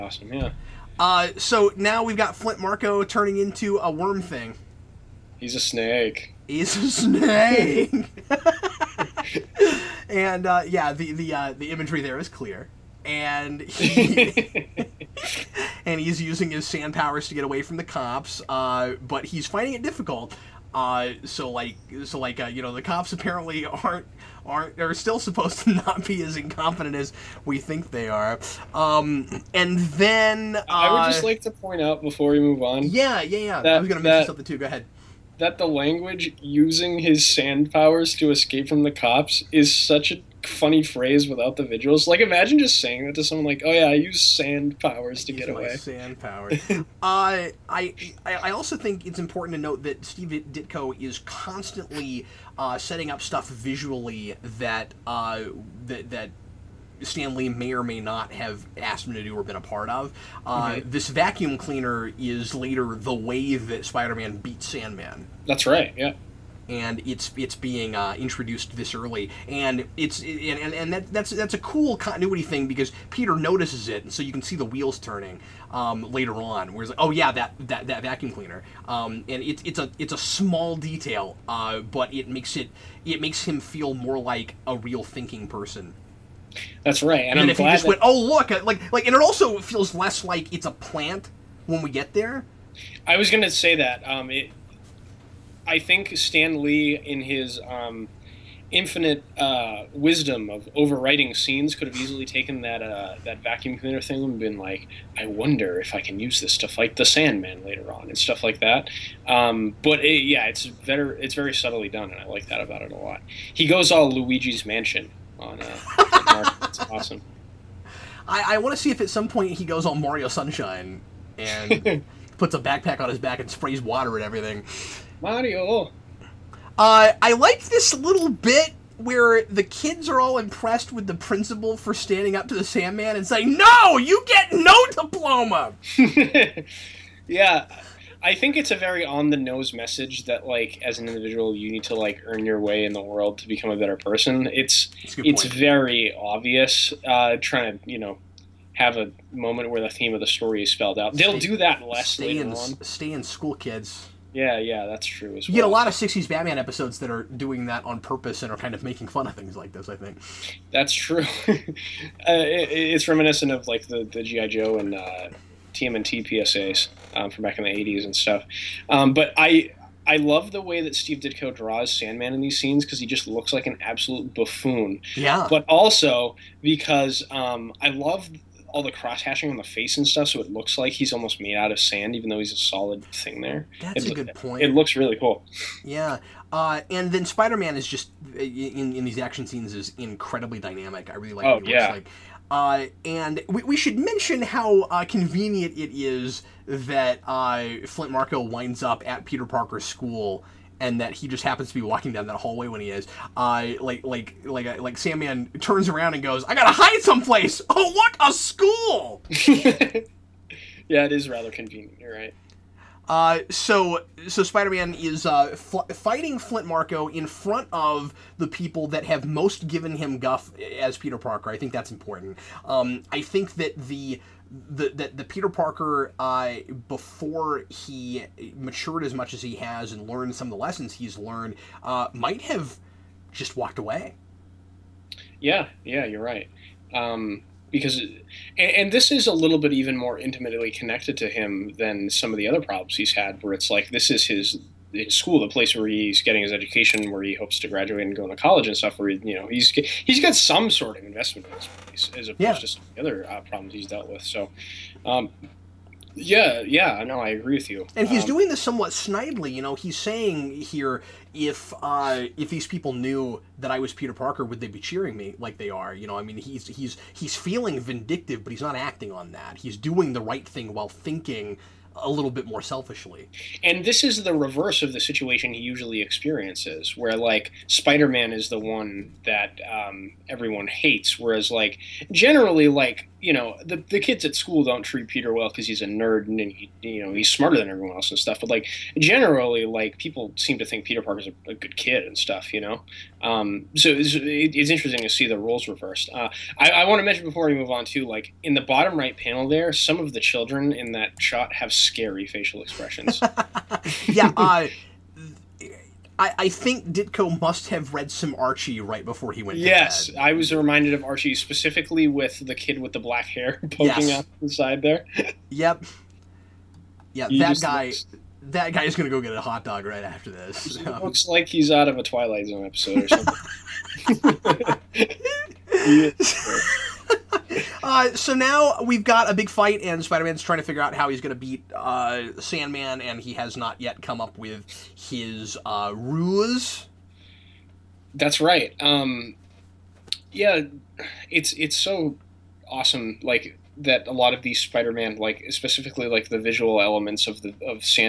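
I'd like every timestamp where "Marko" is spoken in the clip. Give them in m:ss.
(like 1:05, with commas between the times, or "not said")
0:02, 3:18, 3:36.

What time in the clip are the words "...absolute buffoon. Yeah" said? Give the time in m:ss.
2:53.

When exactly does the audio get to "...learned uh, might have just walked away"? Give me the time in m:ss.
3:51.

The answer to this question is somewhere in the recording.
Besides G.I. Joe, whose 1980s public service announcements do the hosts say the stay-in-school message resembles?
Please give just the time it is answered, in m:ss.
2:45.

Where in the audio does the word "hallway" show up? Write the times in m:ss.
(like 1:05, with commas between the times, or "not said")
3:22.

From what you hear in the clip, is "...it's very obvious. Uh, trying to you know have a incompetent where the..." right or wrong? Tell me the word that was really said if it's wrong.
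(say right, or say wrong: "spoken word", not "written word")
wrong: "moment", not "incompetent".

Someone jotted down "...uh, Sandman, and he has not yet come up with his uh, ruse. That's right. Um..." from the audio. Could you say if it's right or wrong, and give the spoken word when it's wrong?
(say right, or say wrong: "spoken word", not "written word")
right.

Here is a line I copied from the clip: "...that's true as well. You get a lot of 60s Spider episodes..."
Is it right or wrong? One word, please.
wrong.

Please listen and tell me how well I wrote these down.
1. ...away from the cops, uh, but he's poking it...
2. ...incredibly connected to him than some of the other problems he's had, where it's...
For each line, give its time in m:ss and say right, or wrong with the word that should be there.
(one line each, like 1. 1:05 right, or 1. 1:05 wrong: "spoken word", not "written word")
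1. 0:17 wrong: "finding", not "poking"
2. 4:00 wrong: "intimately", not "incredibly".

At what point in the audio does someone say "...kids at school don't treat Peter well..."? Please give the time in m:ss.
4:43.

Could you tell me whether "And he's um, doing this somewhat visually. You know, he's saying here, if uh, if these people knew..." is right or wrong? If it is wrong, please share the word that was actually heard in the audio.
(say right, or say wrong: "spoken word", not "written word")
wrong: "snidely", not "visually".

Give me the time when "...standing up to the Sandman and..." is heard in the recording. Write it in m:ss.
2:11.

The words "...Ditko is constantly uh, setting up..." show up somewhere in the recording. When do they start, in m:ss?
0:50.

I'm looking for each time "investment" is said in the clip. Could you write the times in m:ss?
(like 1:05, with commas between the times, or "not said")
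4:11.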